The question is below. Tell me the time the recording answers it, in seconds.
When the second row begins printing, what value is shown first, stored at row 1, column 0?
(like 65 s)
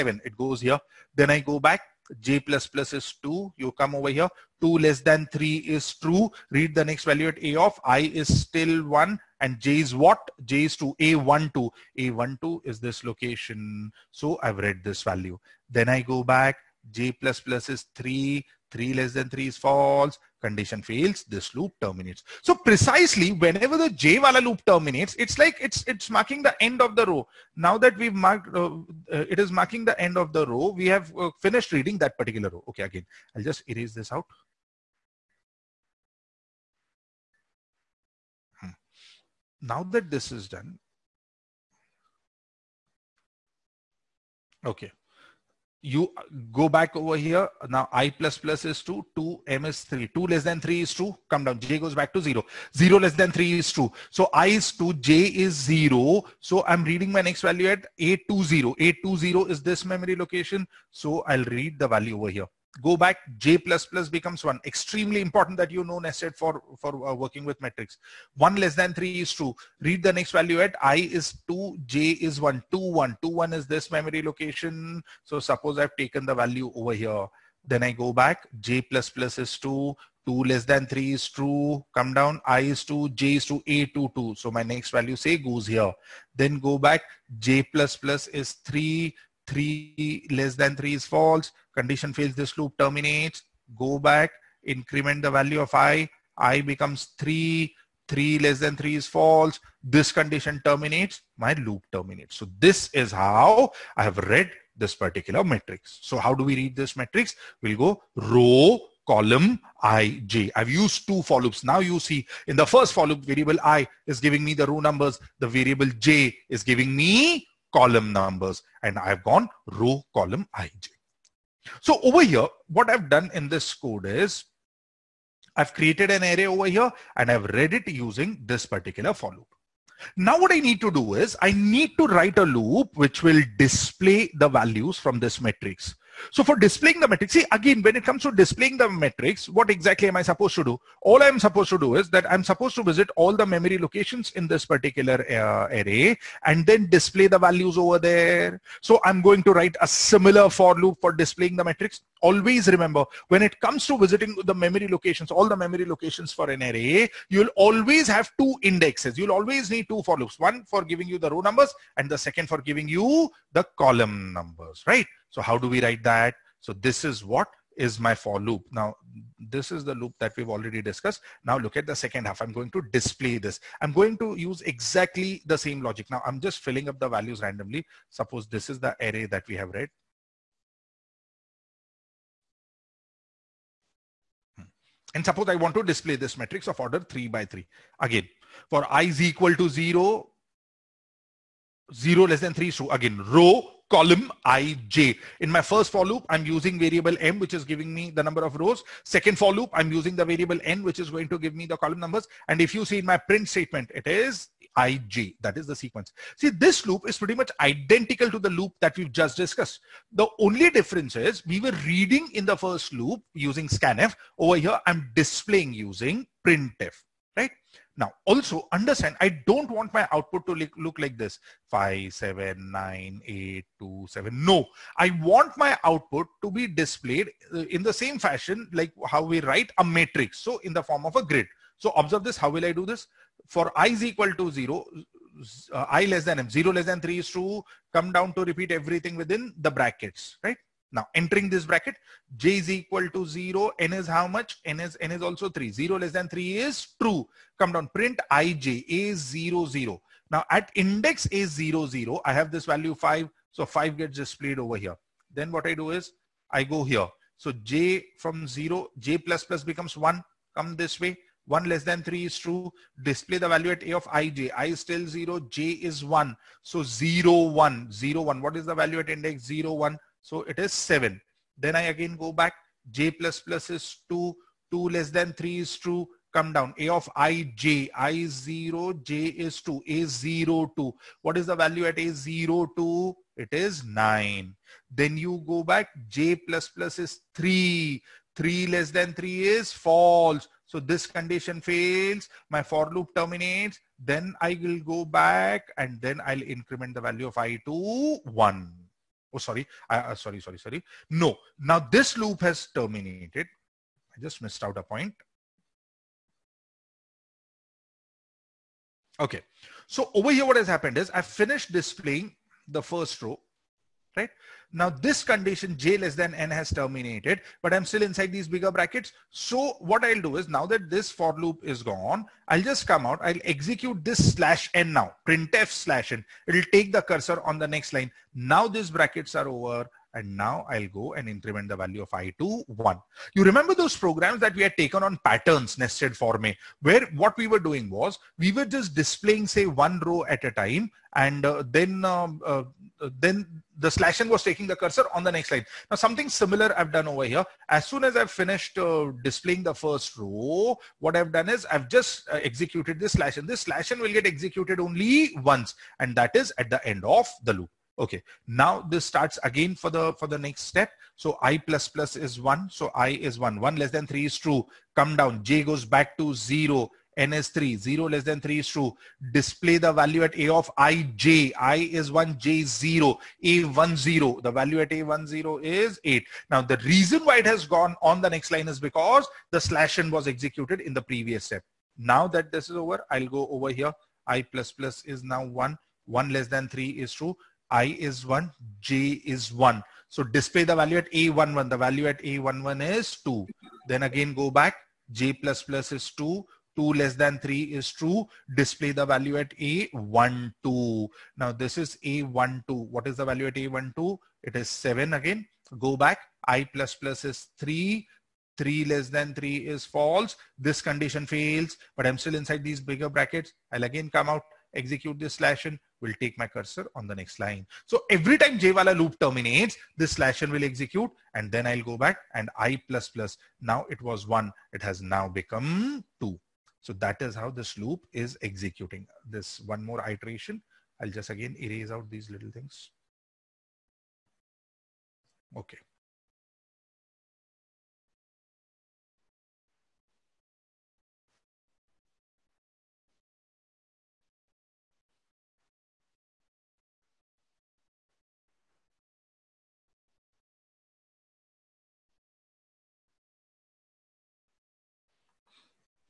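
374 s.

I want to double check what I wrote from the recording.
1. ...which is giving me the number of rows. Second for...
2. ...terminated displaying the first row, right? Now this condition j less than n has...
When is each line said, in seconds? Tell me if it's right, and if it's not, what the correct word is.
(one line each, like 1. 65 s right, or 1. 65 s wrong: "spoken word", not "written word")
1. 197 s right
2. 311 s wrong: "finished", not "terminated".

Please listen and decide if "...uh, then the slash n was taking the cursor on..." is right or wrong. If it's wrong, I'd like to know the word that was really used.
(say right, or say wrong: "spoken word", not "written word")
right.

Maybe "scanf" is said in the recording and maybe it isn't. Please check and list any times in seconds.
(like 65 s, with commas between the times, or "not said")
213 s.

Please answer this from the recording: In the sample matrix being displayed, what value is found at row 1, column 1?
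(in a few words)
2.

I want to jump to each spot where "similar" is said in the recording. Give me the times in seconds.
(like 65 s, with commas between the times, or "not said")
149 s, 346 s.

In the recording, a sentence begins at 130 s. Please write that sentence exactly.
Now what I need to do is I need to write a loop which will display the values from this matrix.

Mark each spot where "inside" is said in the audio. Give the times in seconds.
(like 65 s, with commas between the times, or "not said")
318 s, 412 s.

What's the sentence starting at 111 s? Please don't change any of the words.
Now you see in the first for loop, variable i is giving me the row numbers.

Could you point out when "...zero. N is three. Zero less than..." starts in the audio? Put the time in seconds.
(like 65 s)
366 s.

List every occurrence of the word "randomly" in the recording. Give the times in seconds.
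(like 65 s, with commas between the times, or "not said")
177 s.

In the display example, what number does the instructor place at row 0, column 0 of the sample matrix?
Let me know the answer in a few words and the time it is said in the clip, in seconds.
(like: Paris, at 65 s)
5, at 253 s.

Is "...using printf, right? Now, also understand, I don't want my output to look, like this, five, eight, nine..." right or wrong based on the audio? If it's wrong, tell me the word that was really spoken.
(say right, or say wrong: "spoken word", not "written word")
wrong: "seven", not "eight".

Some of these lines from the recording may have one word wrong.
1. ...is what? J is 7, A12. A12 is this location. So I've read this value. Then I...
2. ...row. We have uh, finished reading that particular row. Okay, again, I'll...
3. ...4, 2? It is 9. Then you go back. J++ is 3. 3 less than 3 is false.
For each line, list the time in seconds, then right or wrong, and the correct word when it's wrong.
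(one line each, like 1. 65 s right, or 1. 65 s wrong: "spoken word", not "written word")
1. 9 s wrong: "2", not "7"
2. 30 s right
3. 282 s wrong: "0", not "4".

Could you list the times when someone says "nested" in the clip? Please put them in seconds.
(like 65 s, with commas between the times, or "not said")
65 s, 335 s.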